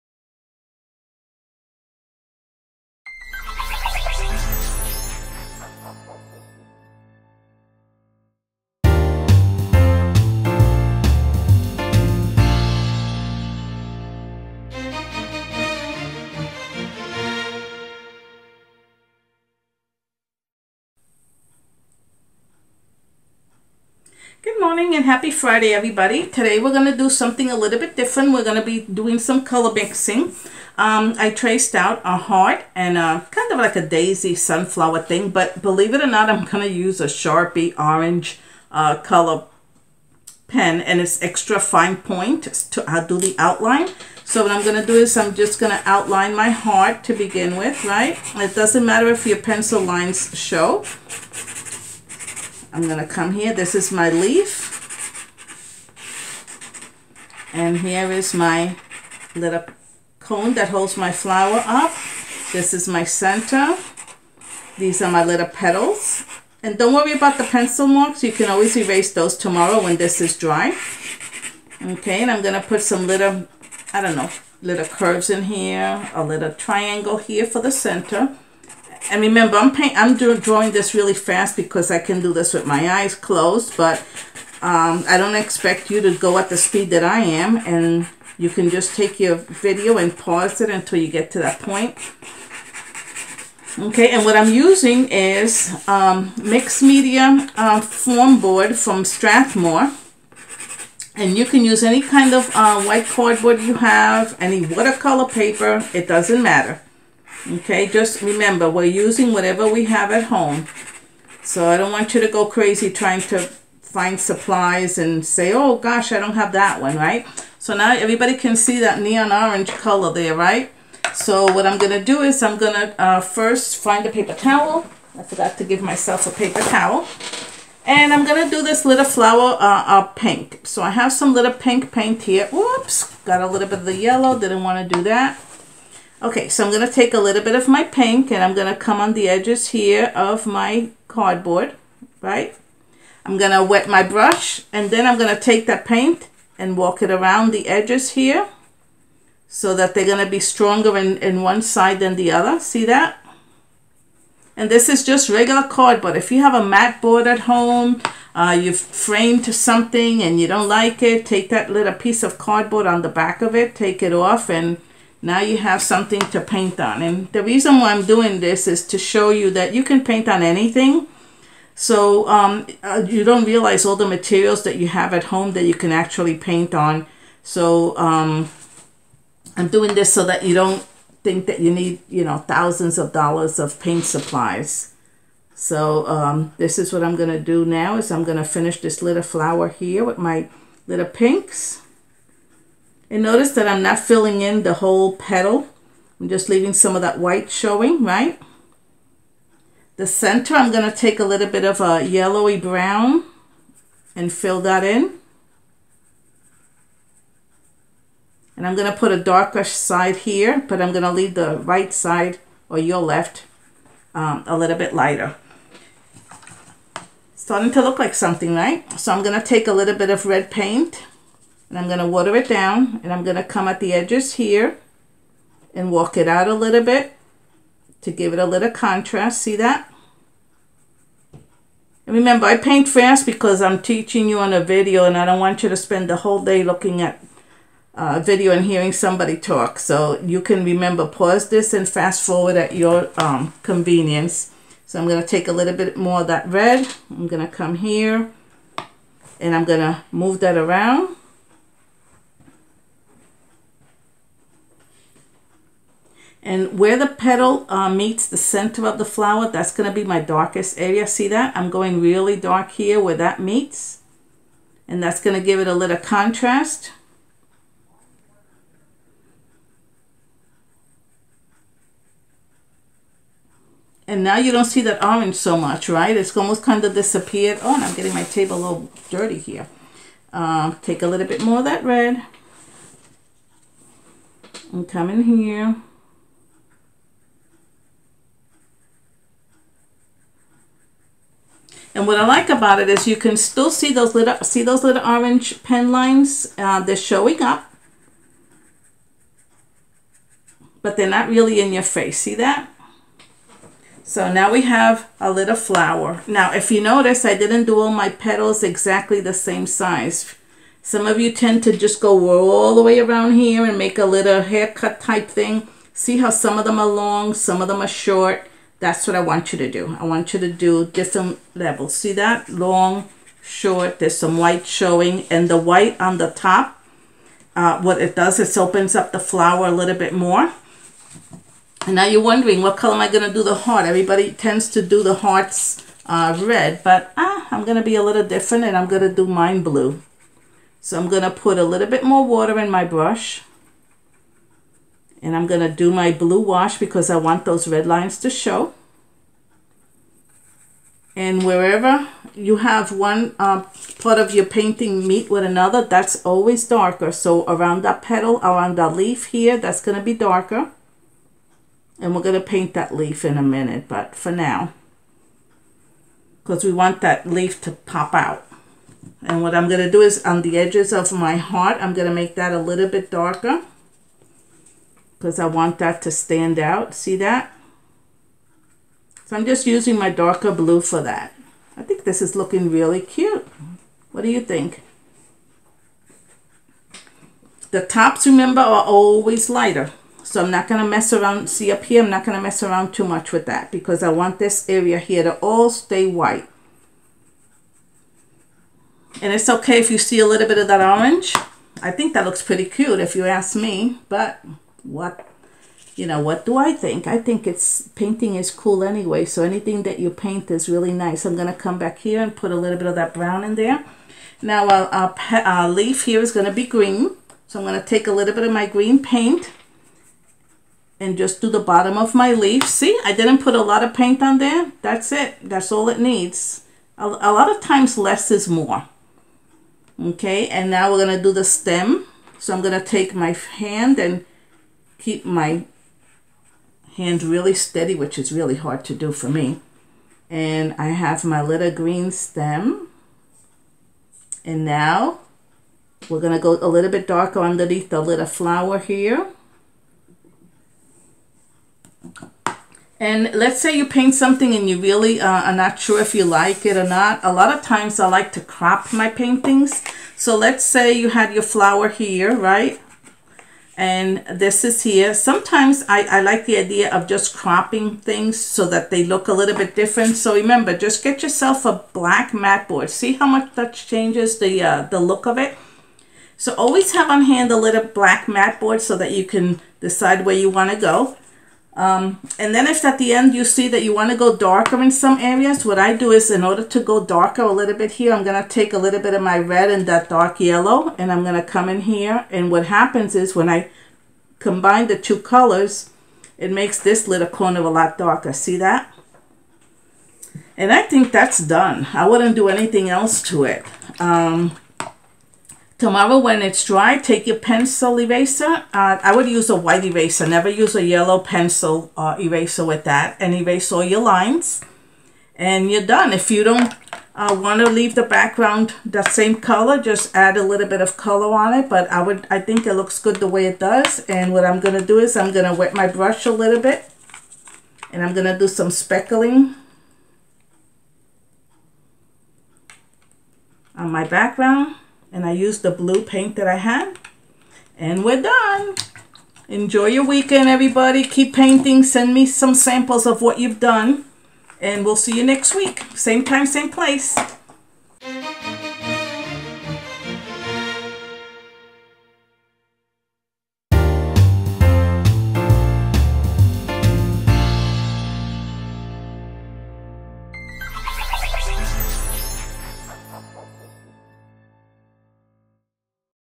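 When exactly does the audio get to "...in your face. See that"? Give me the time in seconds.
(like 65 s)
301 s.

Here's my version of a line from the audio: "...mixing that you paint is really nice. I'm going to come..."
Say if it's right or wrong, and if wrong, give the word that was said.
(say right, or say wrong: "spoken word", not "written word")
wrong: "anything", not "mixing".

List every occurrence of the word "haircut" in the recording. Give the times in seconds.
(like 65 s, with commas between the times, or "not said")
314 s.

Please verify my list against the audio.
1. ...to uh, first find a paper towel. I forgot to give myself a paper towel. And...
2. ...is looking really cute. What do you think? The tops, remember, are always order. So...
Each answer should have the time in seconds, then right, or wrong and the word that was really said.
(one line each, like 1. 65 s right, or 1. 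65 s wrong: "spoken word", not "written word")
1. 122 s right
2. 382 s wrong: "lighter", not "order".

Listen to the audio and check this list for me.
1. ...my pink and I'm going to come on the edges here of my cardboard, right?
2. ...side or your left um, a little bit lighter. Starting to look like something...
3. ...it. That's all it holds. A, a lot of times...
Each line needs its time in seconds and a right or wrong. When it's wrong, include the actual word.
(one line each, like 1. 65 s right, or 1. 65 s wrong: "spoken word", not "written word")
1. 137 s right
2. 211 s right
3. 425 s wrong: "needs", not "holds".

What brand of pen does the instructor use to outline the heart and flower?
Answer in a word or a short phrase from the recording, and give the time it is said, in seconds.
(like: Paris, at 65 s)
Sharpie, at 37 s.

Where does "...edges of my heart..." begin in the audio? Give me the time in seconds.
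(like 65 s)
370 s.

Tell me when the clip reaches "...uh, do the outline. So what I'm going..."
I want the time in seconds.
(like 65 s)
43 s.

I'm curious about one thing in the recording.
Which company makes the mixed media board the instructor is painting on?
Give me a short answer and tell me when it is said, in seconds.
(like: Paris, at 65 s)
Strathmore, at 99 s.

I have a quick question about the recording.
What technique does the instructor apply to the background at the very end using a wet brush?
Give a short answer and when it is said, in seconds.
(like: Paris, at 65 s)
Speckling, at 528 s.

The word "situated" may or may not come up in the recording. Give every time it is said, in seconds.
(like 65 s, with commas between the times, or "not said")
not said.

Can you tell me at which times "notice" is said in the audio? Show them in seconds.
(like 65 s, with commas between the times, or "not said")
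193 s, 306 s.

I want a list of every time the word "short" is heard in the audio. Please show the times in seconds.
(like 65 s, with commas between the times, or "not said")
318 s, 323 s.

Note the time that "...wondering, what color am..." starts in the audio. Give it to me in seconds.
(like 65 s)
332 s.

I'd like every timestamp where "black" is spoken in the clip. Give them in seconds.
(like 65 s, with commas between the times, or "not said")
471 s, 477 s.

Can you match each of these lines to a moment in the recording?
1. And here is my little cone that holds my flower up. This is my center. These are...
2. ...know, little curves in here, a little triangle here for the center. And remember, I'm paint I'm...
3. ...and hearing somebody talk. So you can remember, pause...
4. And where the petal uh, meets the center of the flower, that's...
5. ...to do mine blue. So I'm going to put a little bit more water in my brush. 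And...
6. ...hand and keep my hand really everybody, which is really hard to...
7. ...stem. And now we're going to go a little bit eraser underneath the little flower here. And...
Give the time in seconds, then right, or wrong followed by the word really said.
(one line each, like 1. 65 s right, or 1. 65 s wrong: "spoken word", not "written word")
1. 57 s right
2. 74 s right
3. 238 s right
4. 256 s right
5. 339 s right
6. 433 s wrong: "steady", not "everybody"
7. 442 s wrong: "darker", not "eraser".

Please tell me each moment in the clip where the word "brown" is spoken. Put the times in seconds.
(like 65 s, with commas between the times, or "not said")
202 s, 413 s.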